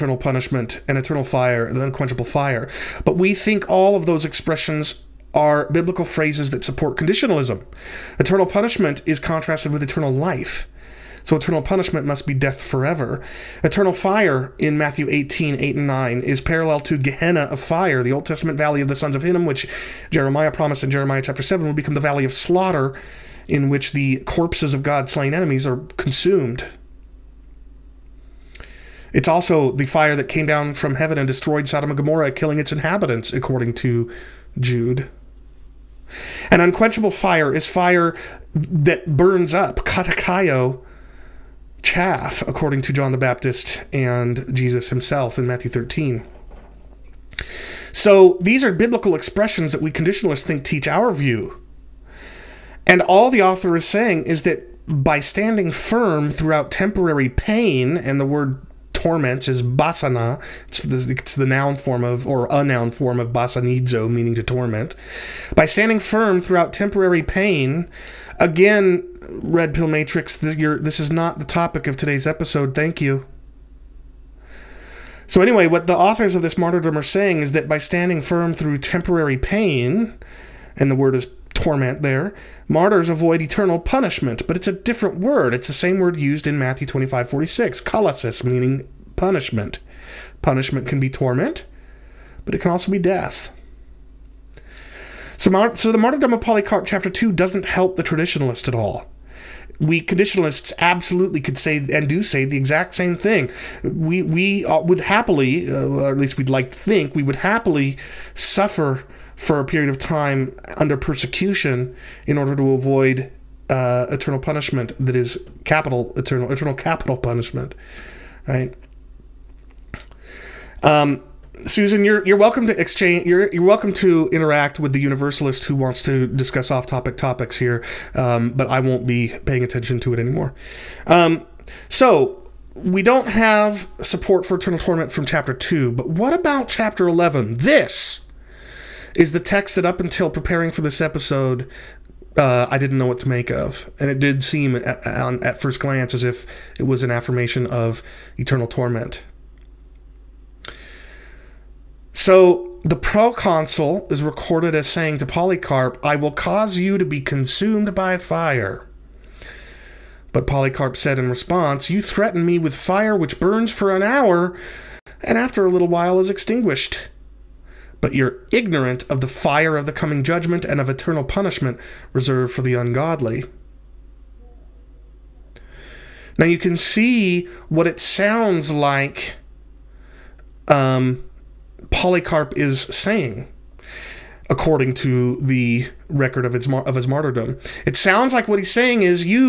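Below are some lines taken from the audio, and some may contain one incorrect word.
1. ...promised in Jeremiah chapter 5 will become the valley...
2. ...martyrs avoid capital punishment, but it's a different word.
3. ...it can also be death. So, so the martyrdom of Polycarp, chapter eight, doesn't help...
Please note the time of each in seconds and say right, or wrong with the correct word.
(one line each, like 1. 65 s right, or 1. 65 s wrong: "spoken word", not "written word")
1. 20 s wrong: "7", not "5"
2. 82 s wrong: "eternal", not "capital"
3. 92 s wrong: "two", not "eight".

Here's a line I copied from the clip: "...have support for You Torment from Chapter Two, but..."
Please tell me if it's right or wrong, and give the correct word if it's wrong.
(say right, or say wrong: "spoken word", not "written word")
wrong: "Eternal", not "You".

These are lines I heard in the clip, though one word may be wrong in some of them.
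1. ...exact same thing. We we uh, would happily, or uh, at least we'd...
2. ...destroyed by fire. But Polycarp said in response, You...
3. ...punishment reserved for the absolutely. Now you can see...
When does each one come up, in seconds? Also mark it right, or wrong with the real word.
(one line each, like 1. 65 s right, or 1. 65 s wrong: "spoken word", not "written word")
1. 102 s right
2. 157 s wrong: "consumed", not "destroyed"
3. 171 s wrong: "ungodly", not "absolutely".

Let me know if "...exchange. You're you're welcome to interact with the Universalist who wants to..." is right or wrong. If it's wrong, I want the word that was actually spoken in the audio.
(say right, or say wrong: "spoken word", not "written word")
right.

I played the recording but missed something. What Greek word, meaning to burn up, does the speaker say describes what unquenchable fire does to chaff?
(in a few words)
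katakayo.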